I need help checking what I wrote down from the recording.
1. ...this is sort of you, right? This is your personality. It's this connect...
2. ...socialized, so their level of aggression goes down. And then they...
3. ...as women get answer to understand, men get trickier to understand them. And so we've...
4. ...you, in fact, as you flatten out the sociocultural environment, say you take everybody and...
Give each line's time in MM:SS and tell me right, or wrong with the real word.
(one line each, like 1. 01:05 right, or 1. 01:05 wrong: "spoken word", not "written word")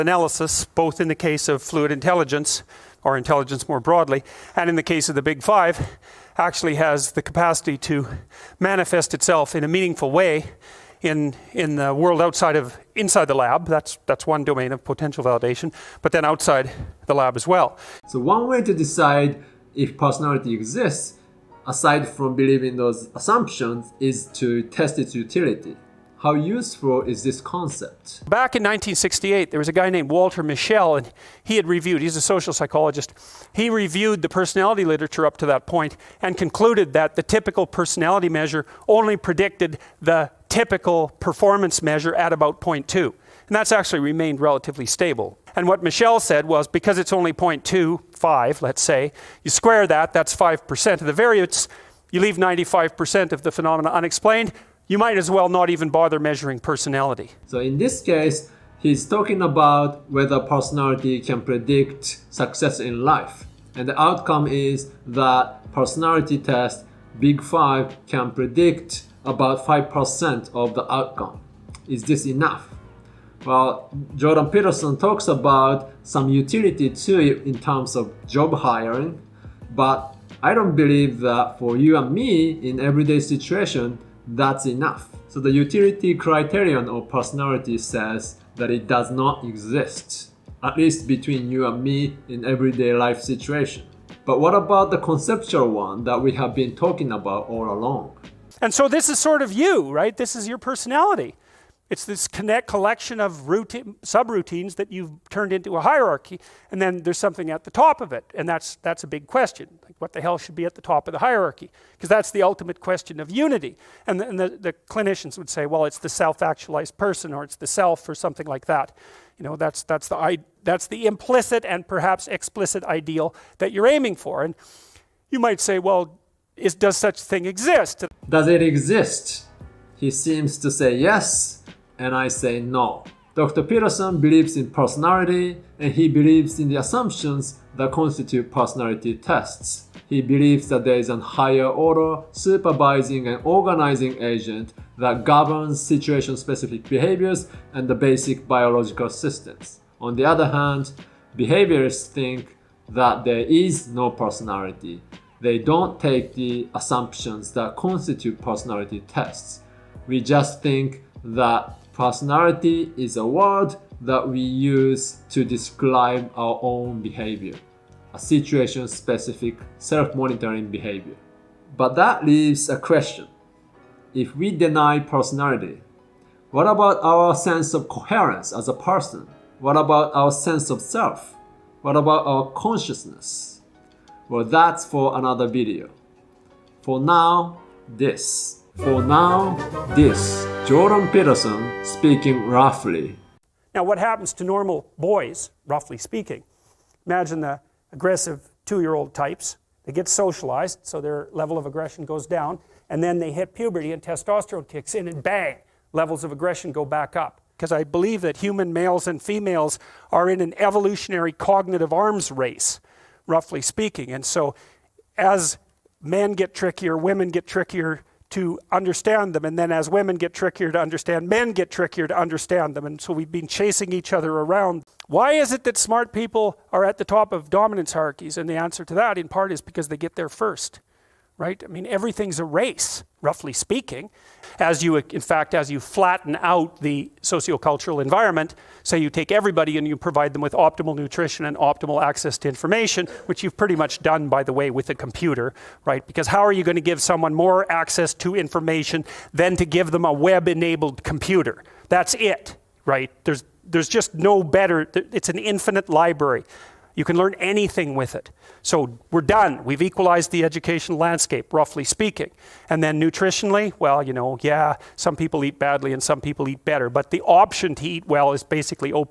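1. 01:38 right
2. 03:20 right
3. 03:39 wrong: "trickier", not "answer"
4. 03:54 right.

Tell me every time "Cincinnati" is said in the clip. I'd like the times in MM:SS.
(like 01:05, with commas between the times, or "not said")
not said.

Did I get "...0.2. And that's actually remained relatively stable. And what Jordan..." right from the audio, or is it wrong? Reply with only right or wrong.
wrong.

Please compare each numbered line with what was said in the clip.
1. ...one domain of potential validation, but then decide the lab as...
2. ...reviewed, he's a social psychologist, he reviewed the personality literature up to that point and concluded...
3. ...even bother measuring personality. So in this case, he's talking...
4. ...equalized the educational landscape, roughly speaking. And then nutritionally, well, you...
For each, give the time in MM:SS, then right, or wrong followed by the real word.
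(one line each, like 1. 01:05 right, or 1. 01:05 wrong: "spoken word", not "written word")
1. 00:14 wrong: "outside", not "decide"
2. 00:31 right
3. 00:55 right
4. 04:19 right.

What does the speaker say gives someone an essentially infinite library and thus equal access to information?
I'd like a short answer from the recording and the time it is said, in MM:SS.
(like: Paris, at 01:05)
a web-enabled computer, at 04:10.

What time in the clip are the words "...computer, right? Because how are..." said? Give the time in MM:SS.
04:04.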